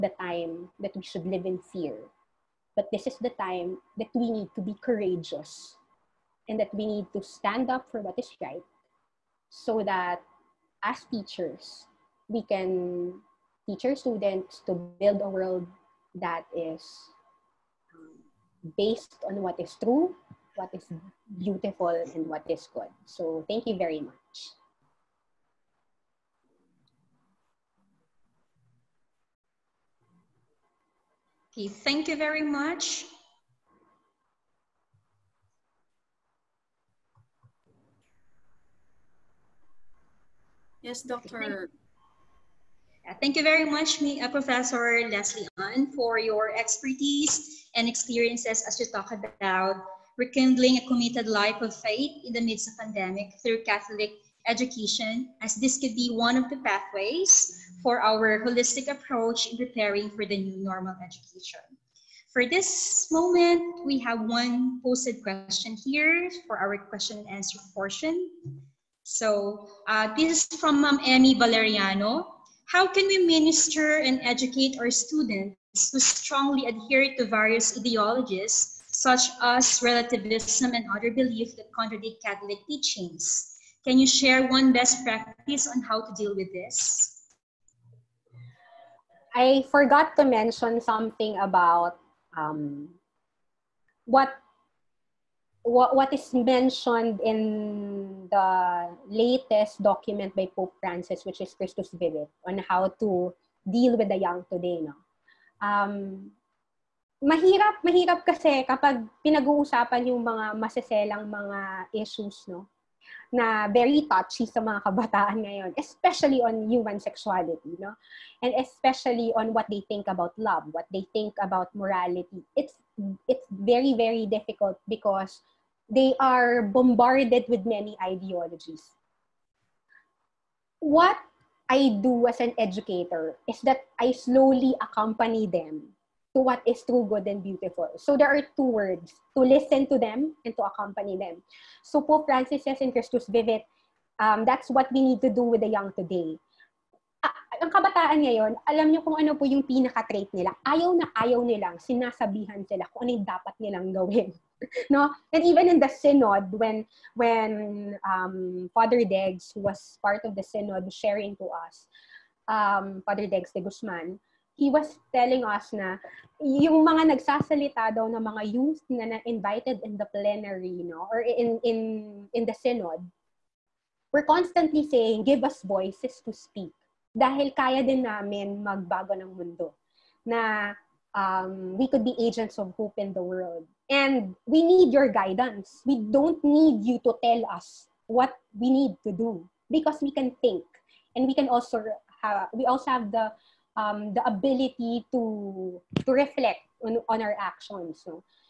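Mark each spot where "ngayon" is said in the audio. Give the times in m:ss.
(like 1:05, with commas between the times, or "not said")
1:55, 2:28.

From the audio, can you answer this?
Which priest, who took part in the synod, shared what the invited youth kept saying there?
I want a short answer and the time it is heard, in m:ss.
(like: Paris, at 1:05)
Father Degs de Guzman, at 2:43.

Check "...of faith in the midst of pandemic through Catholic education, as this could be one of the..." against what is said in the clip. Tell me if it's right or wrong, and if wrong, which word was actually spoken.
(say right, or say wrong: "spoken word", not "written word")
right.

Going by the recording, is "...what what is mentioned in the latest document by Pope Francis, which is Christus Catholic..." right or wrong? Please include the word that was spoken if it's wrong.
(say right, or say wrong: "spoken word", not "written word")
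wrong: "Vivit", not "Catholic".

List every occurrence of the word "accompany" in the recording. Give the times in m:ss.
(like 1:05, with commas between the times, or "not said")
2:14, 2:20.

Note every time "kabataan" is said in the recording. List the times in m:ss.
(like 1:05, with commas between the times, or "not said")
1:54, 2:27.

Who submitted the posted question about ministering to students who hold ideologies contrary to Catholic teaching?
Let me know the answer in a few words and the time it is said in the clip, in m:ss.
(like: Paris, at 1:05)
Emmy Valeriano, at 1:11.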